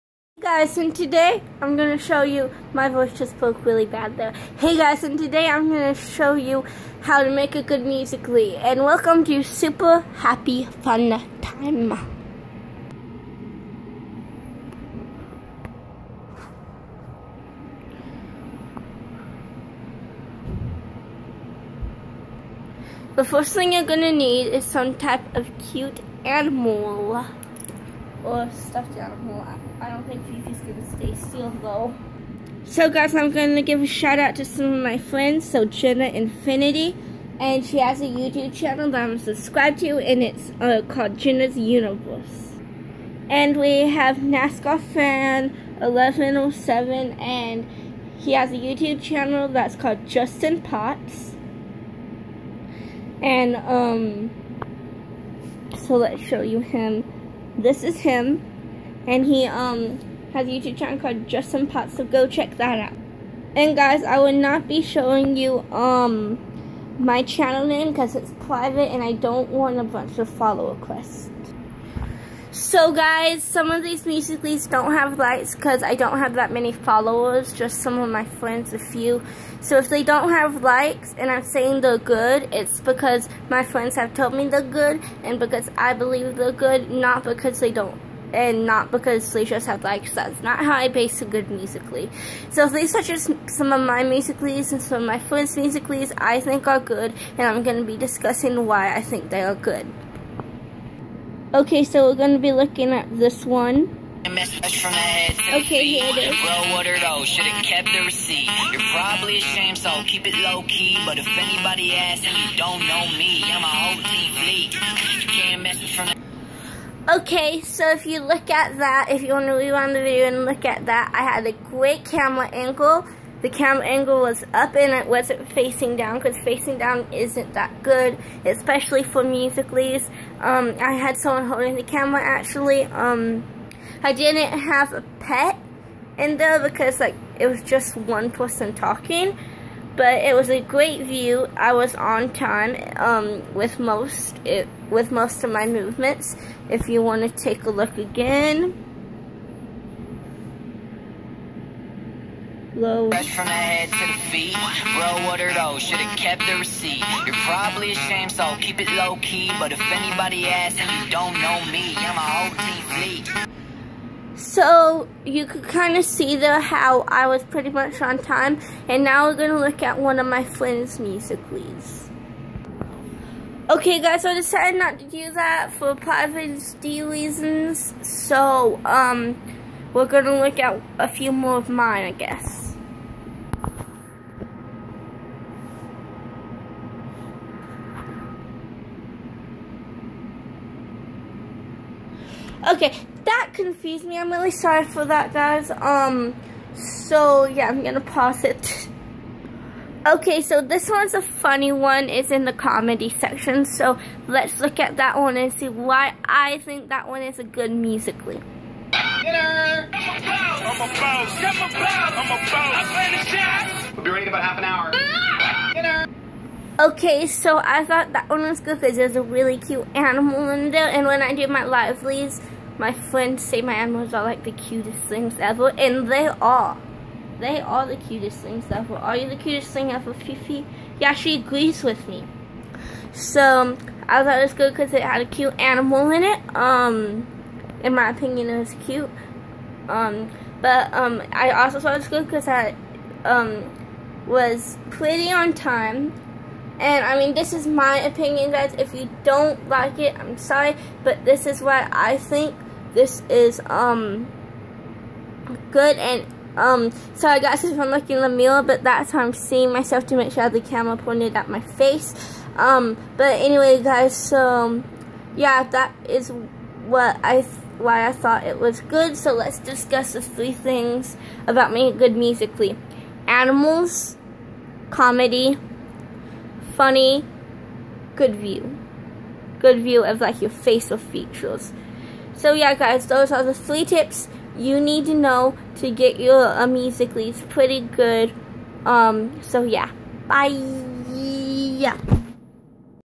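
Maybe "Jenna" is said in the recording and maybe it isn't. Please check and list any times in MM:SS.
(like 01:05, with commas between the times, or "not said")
00:35, 00:41.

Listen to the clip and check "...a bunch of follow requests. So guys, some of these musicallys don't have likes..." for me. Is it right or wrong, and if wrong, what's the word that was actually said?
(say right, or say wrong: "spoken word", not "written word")
right.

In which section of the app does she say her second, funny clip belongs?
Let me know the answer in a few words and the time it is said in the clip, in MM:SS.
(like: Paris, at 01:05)
Comedy section, at 03:22.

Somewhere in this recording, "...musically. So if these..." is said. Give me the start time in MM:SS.
01:31.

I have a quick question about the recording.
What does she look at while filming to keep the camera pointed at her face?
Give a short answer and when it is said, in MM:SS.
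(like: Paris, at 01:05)
The mirror, at 04:18.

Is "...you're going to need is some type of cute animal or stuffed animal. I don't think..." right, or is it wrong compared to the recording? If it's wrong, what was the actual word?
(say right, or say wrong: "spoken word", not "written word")
right.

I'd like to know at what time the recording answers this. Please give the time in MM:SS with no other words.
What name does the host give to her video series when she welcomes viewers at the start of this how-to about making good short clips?
00:09.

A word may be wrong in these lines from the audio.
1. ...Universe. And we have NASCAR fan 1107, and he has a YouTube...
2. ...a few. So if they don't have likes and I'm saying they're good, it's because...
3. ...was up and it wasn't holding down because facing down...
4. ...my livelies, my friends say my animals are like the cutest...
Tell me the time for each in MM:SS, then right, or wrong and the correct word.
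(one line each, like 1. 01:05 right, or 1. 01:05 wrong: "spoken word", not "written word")
1. 00:41 right
2. 01:18 right
3. 02:04 wrong: "facing", not "holding"
4. 03:41 right.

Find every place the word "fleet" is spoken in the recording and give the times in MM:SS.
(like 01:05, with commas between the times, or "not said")
01:54, 02:42.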